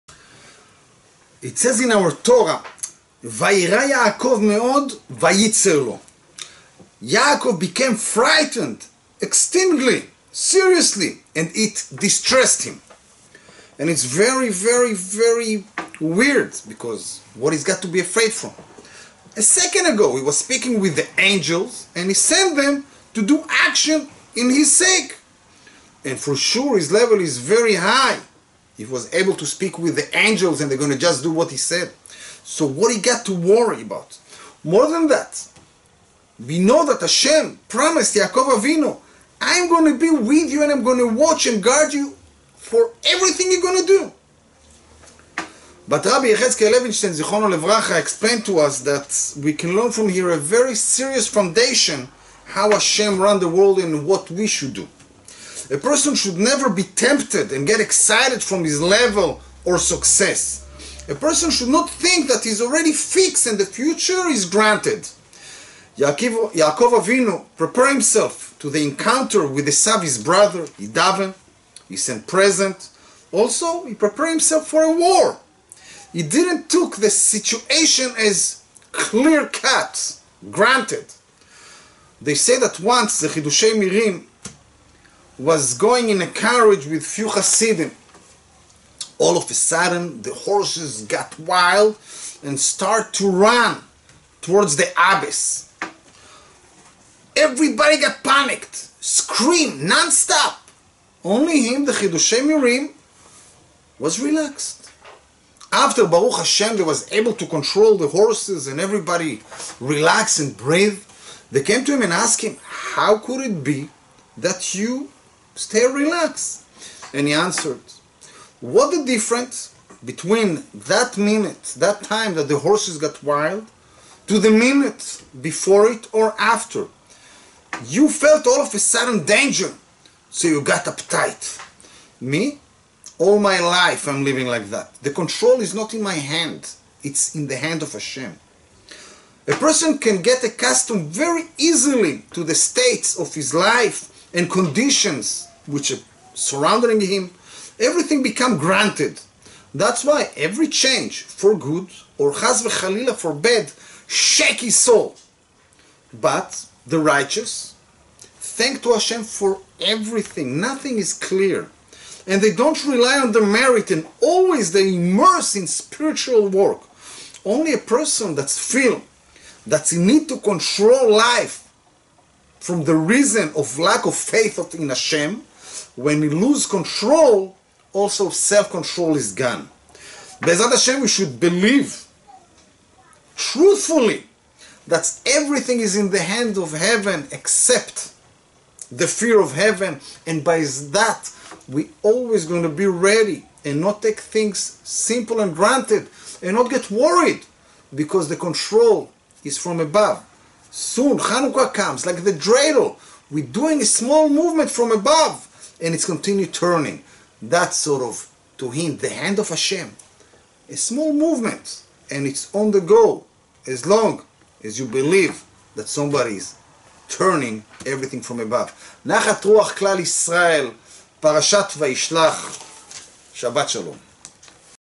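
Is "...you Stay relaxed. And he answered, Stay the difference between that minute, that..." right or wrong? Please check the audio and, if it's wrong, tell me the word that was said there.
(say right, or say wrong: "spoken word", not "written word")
wrong: "What", not "Stay".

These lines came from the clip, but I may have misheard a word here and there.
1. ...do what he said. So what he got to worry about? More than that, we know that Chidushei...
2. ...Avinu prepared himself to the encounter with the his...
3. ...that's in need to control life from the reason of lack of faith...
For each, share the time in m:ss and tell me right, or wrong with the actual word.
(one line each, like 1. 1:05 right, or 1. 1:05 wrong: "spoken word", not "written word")
1. 0:31 wrong: "Hashem", not "Chidushei"
2. 1:07 right
3. 2:49 right.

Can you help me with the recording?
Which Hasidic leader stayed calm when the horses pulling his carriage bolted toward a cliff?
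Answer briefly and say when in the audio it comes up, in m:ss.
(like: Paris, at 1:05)
Chidushei HaRim, at 1:23.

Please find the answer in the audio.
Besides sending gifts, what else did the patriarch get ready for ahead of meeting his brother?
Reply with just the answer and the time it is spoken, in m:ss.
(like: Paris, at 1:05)
a war, at 1:14.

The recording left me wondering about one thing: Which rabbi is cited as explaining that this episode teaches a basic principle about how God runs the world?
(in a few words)
Rabbi Yechezkel Levinstein.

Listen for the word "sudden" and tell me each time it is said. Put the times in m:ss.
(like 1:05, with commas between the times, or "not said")
1:29, 2:08.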